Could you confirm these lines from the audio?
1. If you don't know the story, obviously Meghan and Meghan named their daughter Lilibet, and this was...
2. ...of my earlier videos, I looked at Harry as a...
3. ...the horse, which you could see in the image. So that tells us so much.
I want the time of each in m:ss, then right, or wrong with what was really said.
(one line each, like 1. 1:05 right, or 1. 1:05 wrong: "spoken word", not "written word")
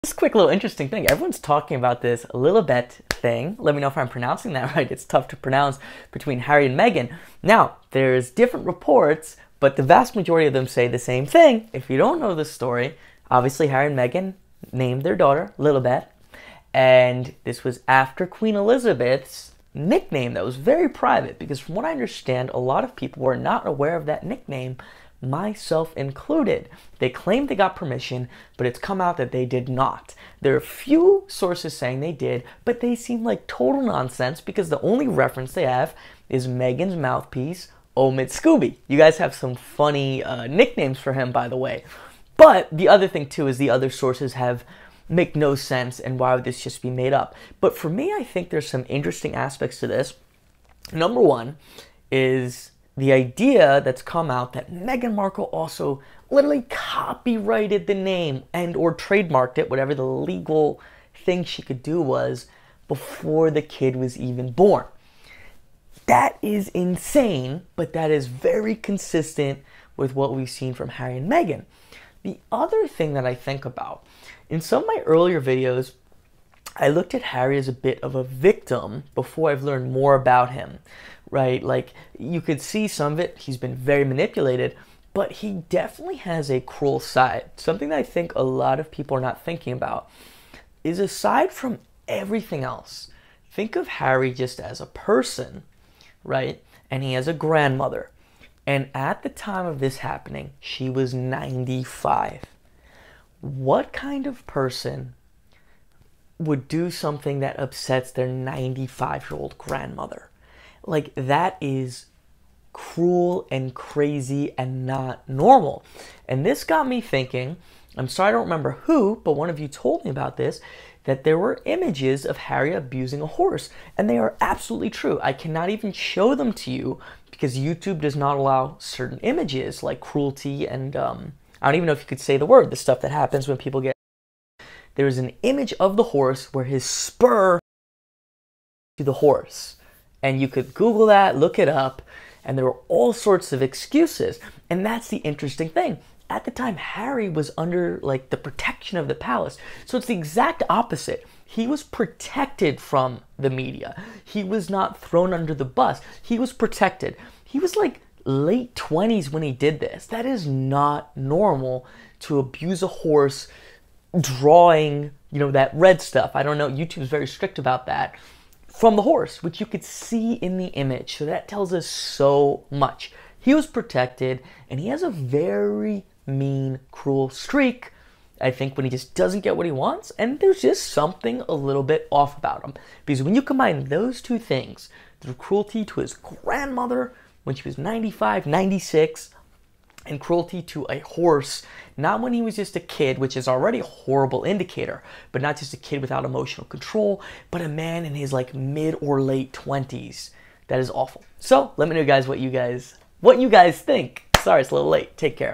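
1. 0:11 wrong: "Harry", not "Meghan"
2. 1:14 right
3. 2:48 right.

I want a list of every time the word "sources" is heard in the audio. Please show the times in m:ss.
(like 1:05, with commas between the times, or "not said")
0:31, 0:43.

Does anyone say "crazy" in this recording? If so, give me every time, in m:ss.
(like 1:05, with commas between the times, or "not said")
1:53.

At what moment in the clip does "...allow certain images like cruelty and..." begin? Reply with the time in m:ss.
2:08.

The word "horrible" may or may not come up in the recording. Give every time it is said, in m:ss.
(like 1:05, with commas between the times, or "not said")
3:13.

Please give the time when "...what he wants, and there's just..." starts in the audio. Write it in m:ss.
2:59.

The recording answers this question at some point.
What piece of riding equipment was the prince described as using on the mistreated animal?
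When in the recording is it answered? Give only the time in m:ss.
2:16.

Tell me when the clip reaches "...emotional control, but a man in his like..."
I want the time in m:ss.
3:16.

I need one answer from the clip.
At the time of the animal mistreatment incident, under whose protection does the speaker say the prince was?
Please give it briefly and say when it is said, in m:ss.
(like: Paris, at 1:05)
The palace, at 2:29.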